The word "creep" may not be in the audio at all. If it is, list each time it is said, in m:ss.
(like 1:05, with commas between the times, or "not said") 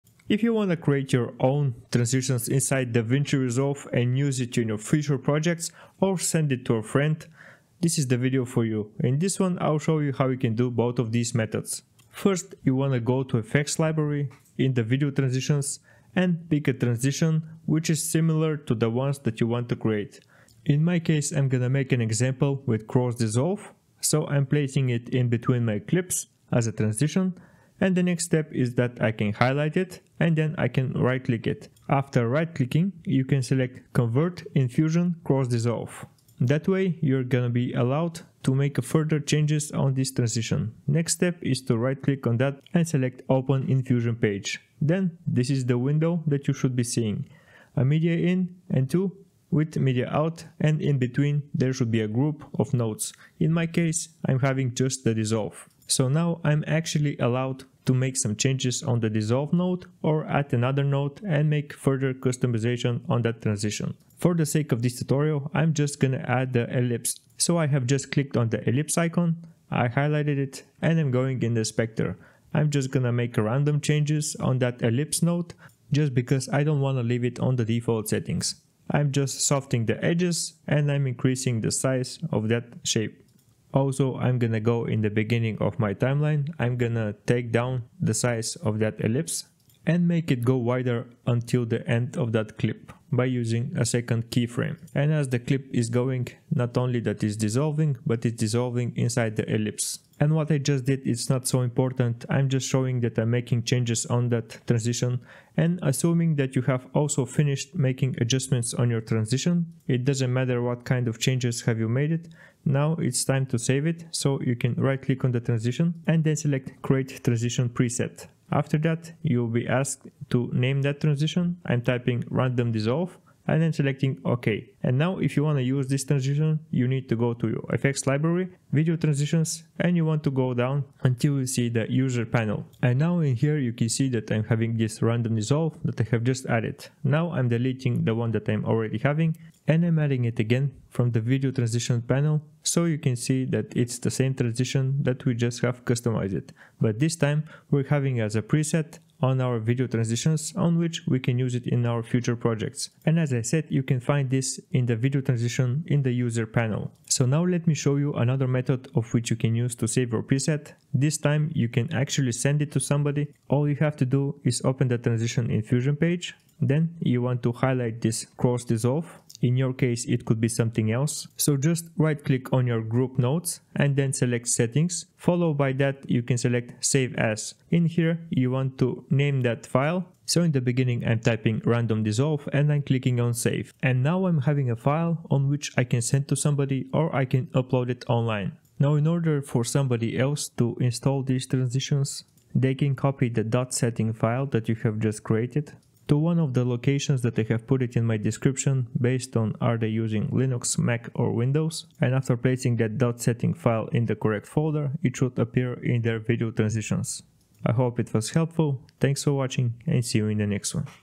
not said.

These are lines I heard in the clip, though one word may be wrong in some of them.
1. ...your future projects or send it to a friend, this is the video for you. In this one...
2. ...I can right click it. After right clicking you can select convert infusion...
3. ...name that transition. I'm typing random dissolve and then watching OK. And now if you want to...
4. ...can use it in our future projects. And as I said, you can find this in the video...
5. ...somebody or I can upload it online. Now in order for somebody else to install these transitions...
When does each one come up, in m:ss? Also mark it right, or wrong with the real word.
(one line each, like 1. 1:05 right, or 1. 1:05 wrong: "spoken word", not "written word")
1. 0:04 right
2. 0:30 right
3. 2:00 wrong: "selecting", not "watching"
4. 2:31 right
5. 3:06 right.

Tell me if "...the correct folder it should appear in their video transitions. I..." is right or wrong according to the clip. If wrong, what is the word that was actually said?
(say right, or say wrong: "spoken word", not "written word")
right.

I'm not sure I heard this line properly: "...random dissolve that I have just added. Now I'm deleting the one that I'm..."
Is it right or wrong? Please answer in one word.
right.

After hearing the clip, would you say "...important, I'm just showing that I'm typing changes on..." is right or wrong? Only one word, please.
wrong.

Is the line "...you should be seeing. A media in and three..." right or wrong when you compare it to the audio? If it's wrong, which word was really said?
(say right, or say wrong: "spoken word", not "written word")
wrong: "two", not "three".